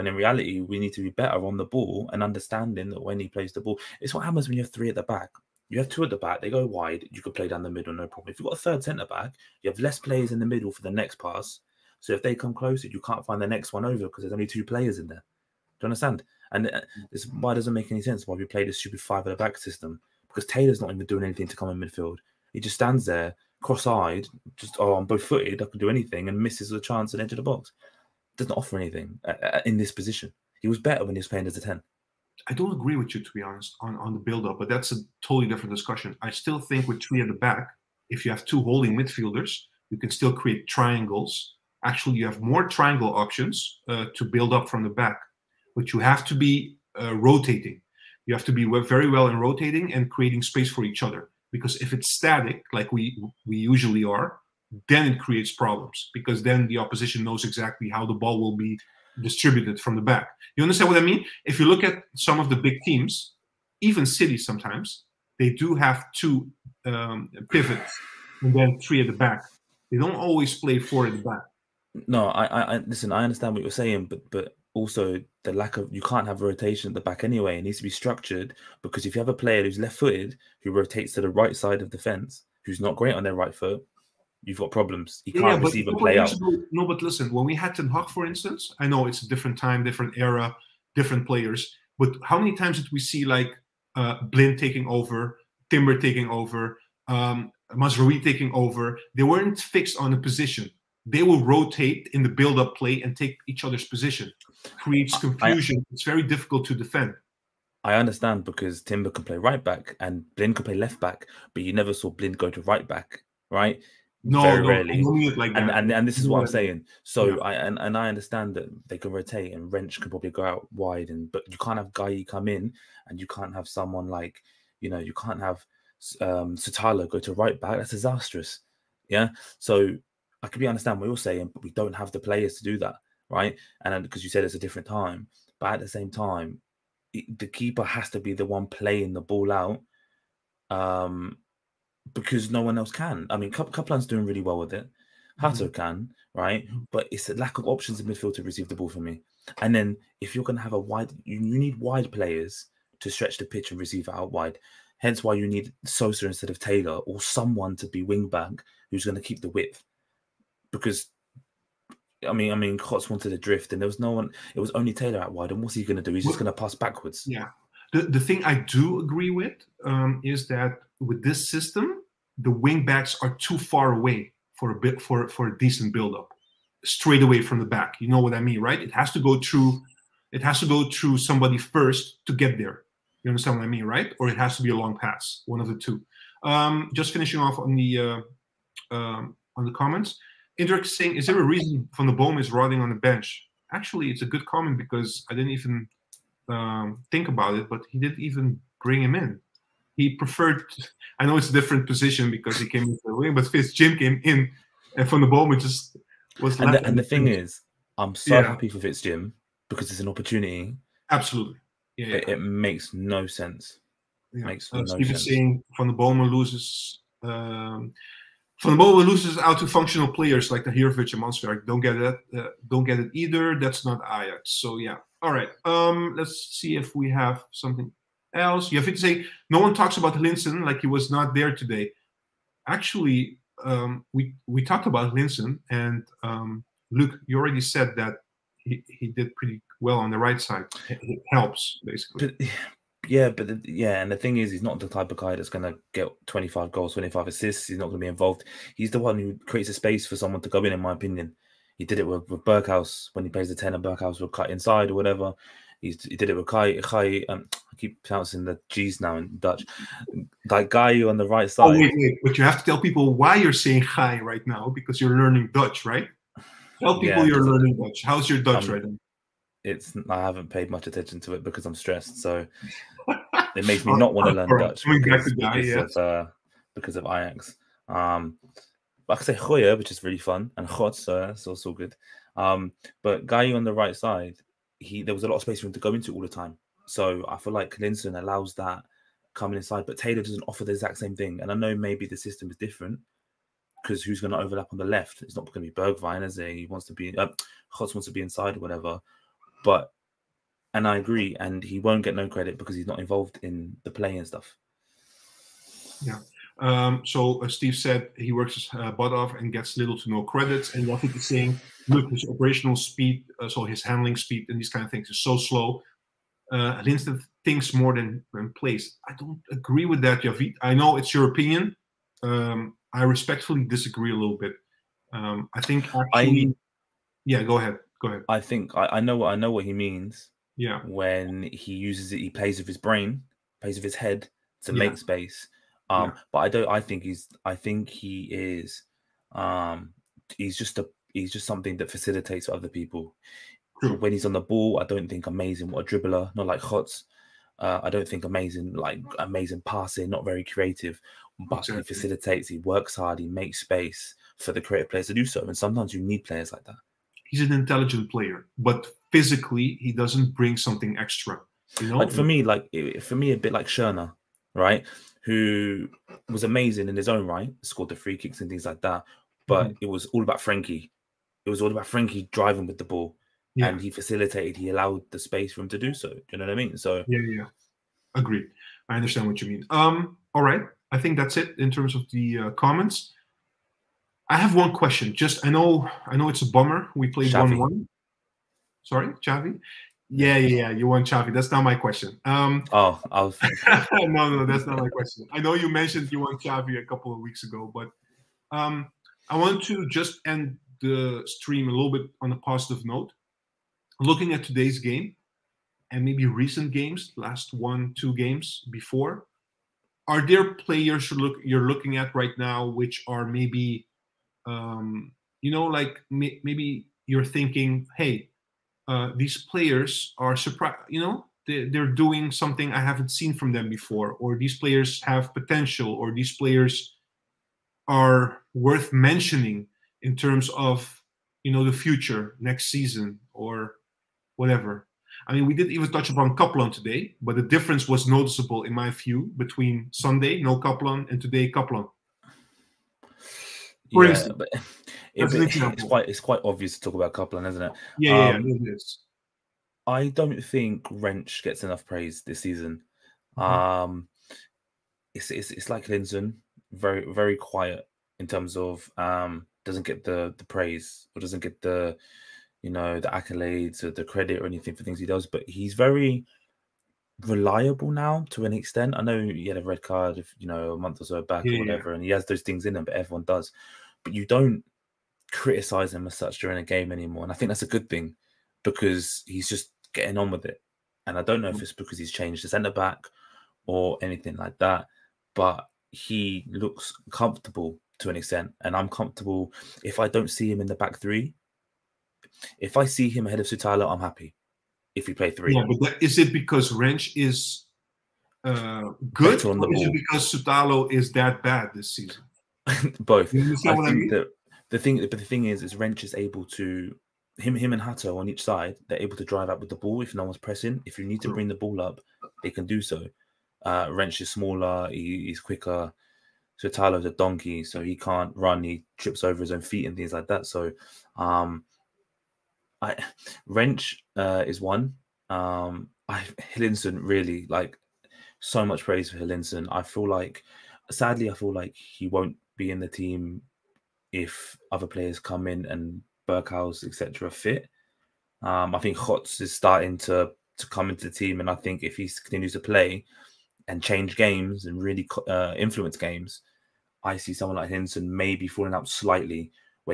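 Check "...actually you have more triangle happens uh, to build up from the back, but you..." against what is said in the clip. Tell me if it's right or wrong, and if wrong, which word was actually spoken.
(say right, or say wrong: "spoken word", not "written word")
wrong: "options", not "happens".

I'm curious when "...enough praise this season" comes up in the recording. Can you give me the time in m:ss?
7:31.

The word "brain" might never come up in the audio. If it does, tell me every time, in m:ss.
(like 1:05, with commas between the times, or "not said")
5:32.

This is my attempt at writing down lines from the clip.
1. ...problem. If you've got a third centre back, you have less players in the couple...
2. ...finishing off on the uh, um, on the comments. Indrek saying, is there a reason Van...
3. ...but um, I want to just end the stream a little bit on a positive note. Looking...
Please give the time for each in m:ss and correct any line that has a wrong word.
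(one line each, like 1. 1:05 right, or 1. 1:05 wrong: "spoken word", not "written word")
1. 0:08 wrong: "middle", not "couple"
2. 3:07 right
3. 6:37 right.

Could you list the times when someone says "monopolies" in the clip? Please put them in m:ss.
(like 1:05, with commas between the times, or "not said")
not said.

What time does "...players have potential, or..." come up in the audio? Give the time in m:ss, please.
7:04.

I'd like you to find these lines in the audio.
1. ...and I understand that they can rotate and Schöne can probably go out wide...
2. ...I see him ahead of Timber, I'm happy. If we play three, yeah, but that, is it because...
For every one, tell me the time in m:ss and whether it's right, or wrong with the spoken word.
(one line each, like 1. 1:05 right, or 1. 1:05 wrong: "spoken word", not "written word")
1. 1:57 wrong: "Rensch", not "Schöne"
2. 8:12 wrong: "Sutalo", not "Timber".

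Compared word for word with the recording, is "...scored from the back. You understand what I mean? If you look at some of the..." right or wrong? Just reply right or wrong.
wrong.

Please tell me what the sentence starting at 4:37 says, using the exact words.
Um, I say Goya, which is really fun, and Chot, so that's also good.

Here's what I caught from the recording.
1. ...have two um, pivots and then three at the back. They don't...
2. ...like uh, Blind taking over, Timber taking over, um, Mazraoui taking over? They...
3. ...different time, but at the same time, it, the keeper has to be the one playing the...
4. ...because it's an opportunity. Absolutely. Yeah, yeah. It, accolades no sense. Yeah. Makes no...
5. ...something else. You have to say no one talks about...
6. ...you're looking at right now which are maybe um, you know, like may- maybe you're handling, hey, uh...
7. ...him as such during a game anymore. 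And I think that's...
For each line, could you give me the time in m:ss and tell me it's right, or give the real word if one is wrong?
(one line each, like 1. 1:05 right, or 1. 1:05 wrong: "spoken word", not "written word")
1. 1:05 right
2. 1:33 right
3. 2:14 right
4. 3:29 wrong: "makes", not "accolades"
5. 3:47 right
6. 6:51 wrong: "thinking", not "handling"
7. 7:55 right.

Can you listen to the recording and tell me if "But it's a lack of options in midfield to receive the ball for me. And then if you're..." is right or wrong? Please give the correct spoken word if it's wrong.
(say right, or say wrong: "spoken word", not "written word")
right.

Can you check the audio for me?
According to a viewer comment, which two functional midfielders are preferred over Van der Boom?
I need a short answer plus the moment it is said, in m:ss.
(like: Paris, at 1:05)
Tahirovic and Mannsverk, at 3:40.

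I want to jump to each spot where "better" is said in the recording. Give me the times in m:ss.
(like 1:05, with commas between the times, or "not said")
0:01, 0:30.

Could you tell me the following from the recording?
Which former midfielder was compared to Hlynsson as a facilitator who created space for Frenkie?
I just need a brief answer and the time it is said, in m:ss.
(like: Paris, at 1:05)
Schöne, at 6:03.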